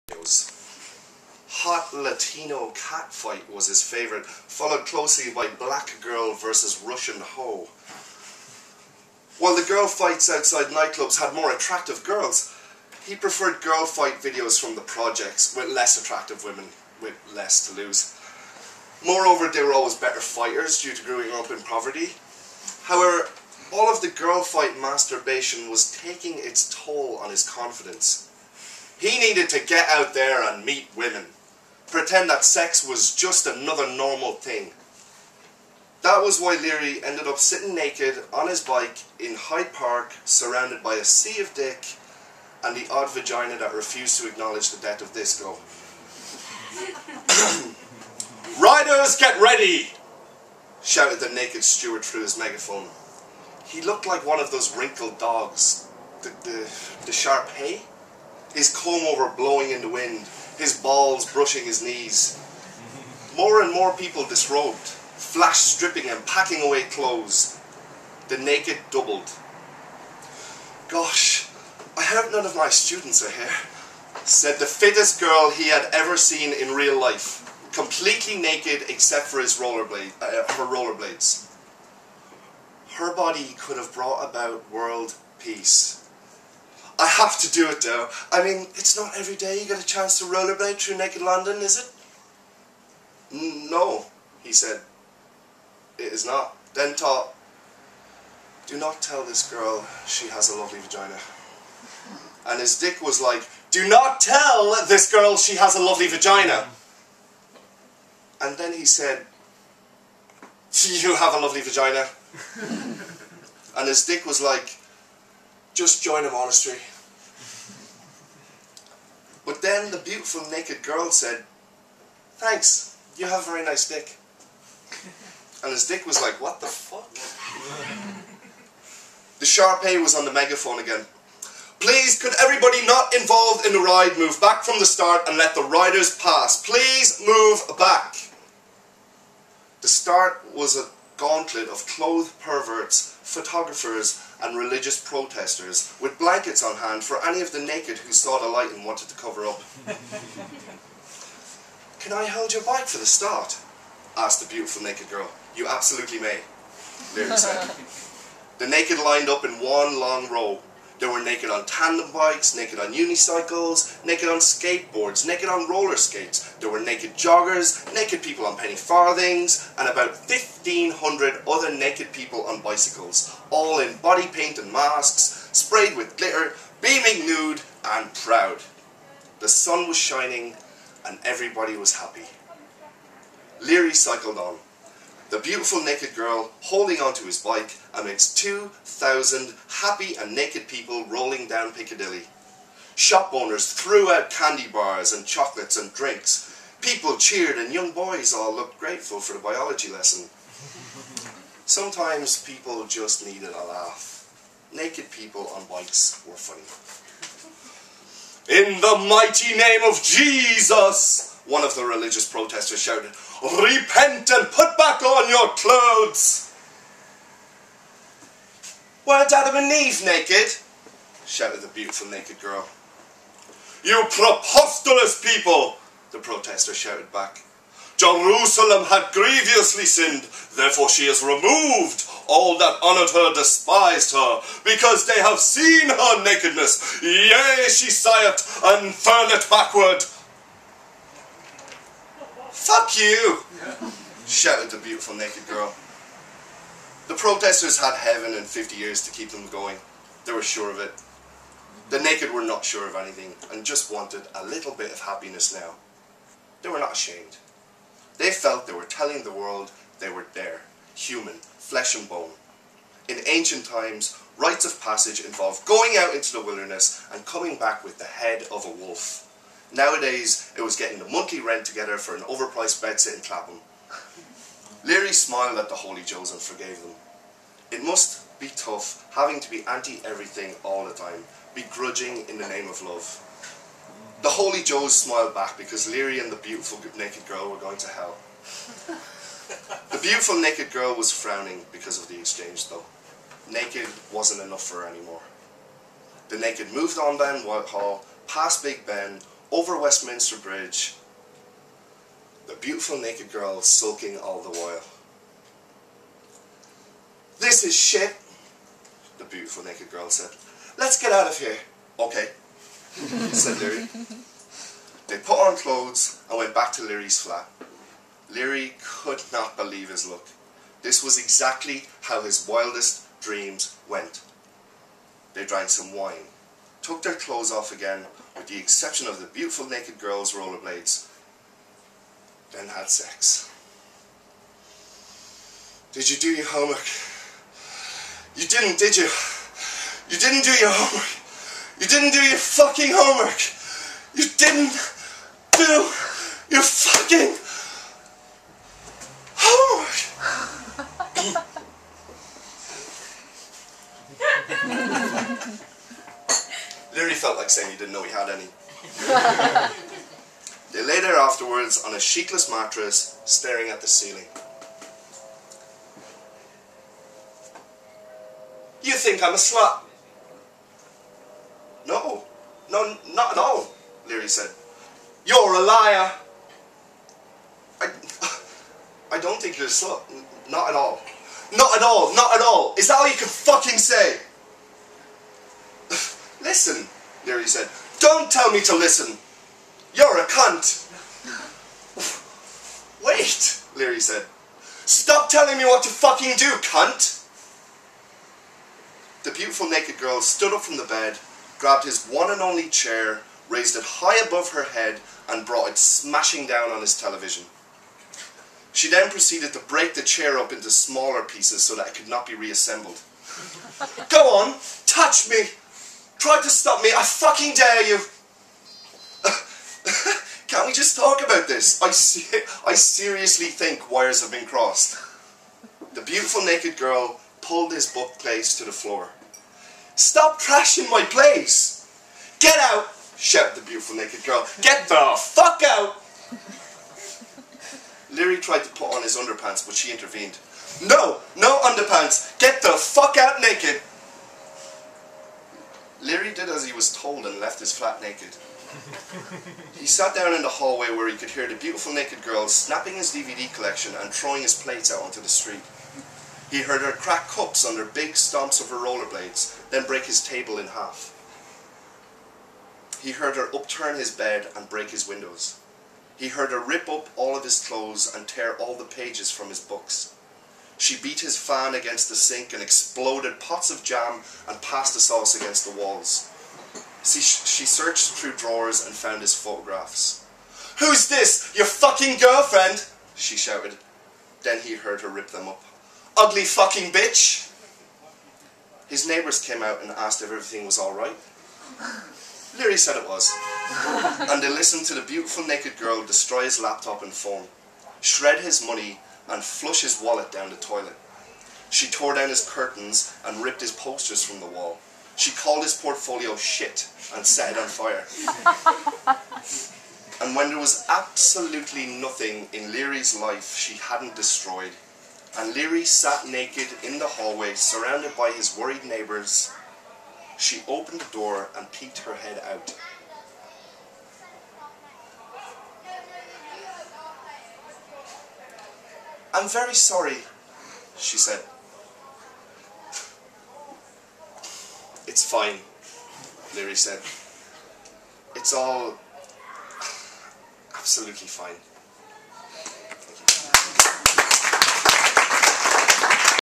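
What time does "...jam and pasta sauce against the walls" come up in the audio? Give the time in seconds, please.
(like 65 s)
473 s.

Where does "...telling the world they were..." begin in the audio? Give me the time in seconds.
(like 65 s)
258 s.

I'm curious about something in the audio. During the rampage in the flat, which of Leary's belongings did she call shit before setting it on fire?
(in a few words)
his portfolio.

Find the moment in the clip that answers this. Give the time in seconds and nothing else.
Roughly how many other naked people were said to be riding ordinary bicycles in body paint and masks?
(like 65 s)
170 s.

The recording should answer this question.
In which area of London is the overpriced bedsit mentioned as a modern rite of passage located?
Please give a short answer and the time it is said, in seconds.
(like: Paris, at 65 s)
Clapham, at 273 s.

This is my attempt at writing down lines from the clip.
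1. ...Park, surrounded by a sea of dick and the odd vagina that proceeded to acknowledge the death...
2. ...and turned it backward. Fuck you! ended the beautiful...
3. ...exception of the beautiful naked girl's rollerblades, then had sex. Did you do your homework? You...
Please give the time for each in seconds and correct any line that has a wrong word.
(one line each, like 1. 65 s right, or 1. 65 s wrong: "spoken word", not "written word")
1. 39 s wrong: "refused", not "proceeded"
2. 238 s wrong: "shouted", not "ended"
3. 328 s right.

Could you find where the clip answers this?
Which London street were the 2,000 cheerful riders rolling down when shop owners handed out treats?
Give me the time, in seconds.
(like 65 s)
191 s.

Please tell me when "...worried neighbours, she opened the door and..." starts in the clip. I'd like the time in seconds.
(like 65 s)
518 s.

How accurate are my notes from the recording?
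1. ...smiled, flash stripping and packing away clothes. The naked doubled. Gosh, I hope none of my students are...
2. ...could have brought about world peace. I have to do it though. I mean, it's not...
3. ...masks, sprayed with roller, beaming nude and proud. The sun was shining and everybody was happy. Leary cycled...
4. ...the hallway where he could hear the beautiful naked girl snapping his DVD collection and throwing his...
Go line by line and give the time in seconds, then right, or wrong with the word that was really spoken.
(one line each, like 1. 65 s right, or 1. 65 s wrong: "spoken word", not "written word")
1. 64 s wrong: "disrobed", not "smiled"
2. 83 s right
3. 174 s wrong: "glitter", not "roller"
4. 450 s right.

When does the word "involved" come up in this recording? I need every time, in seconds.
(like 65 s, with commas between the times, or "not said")
133 s, 265 s.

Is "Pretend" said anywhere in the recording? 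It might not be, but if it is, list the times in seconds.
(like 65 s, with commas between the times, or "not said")
31 s.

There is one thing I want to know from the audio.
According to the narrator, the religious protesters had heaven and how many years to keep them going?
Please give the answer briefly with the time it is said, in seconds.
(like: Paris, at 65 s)
50 years, at 248 s.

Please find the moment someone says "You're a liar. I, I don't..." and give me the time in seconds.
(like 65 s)
375 s.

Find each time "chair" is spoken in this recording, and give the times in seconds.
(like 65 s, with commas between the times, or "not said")
402 s, 410 s.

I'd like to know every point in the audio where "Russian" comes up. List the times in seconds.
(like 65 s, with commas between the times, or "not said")
6 s.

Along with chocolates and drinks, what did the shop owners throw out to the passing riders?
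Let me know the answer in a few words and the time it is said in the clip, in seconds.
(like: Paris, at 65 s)
candy bars, at 194 s.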